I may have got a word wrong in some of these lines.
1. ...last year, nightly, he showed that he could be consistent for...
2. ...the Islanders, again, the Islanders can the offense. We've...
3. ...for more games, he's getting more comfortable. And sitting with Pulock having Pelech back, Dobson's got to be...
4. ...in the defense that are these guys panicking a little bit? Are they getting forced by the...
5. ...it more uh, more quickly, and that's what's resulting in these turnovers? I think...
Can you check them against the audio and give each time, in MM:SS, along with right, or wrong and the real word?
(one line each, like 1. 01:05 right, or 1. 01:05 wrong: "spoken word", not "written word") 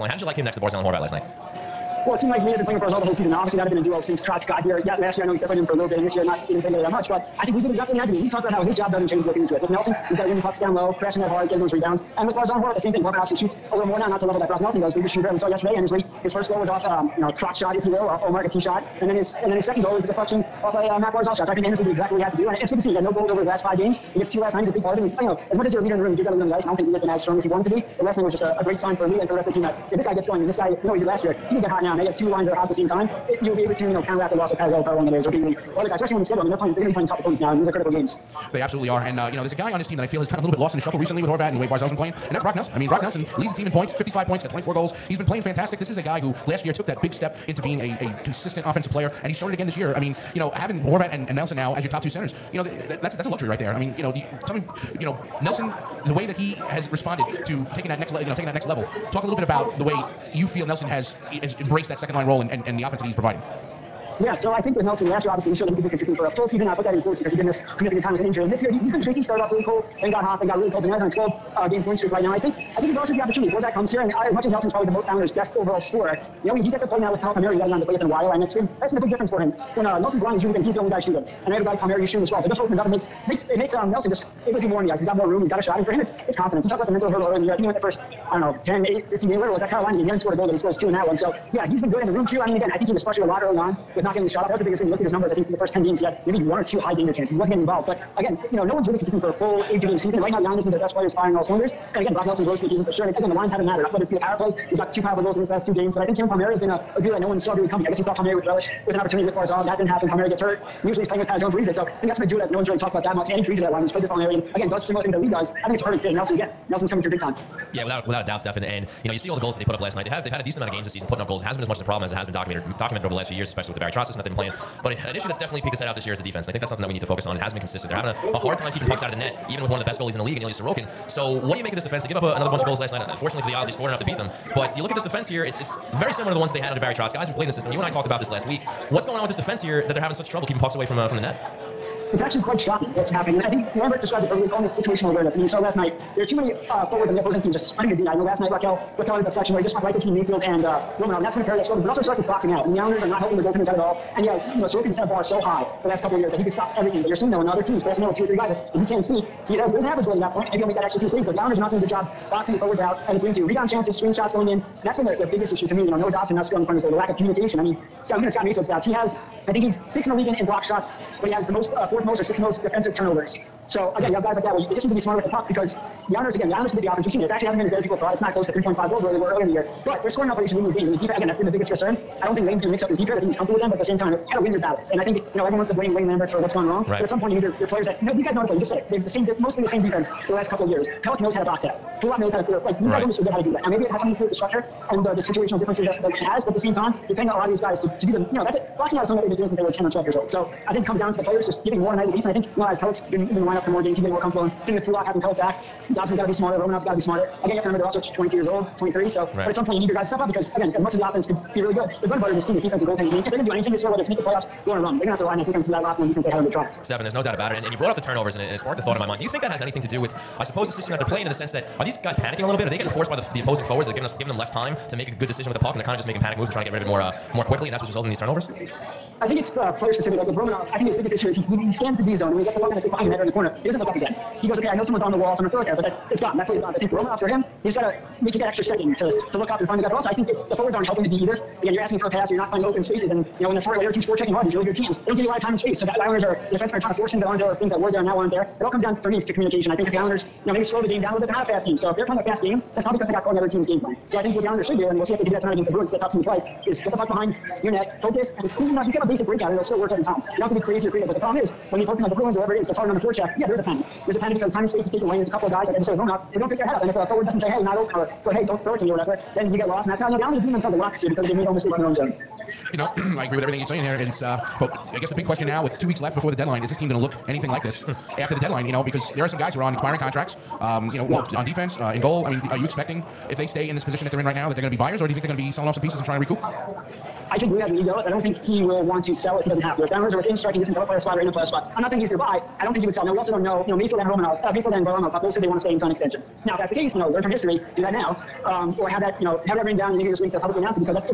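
1. 01:05 wrong: "obviously", not "nightly"
2. 02:56 right
3. 03:23 right
4. 03:41 wrong: "sense", not "defense"
5. 03:46 right.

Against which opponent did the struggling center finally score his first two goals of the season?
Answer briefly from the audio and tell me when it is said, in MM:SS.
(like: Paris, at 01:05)
Carolina, at 01:29.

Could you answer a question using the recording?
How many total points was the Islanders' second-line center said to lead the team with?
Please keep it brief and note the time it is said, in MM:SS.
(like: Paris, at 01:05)
55, at 00:43.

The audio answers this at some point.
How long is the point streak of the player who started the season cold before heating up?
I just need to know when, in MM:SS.
01:11.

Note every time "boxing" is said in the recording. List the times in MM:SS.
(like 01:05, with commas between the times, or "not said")
02:32, 02:42, 03:18.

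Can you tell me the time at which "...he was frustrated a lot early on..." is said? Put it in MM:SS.
01:32.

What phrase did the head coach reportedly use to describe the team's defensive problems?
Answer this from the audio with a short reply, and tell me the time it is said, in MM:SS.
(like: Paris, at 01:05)
situational awareness, at 02:24.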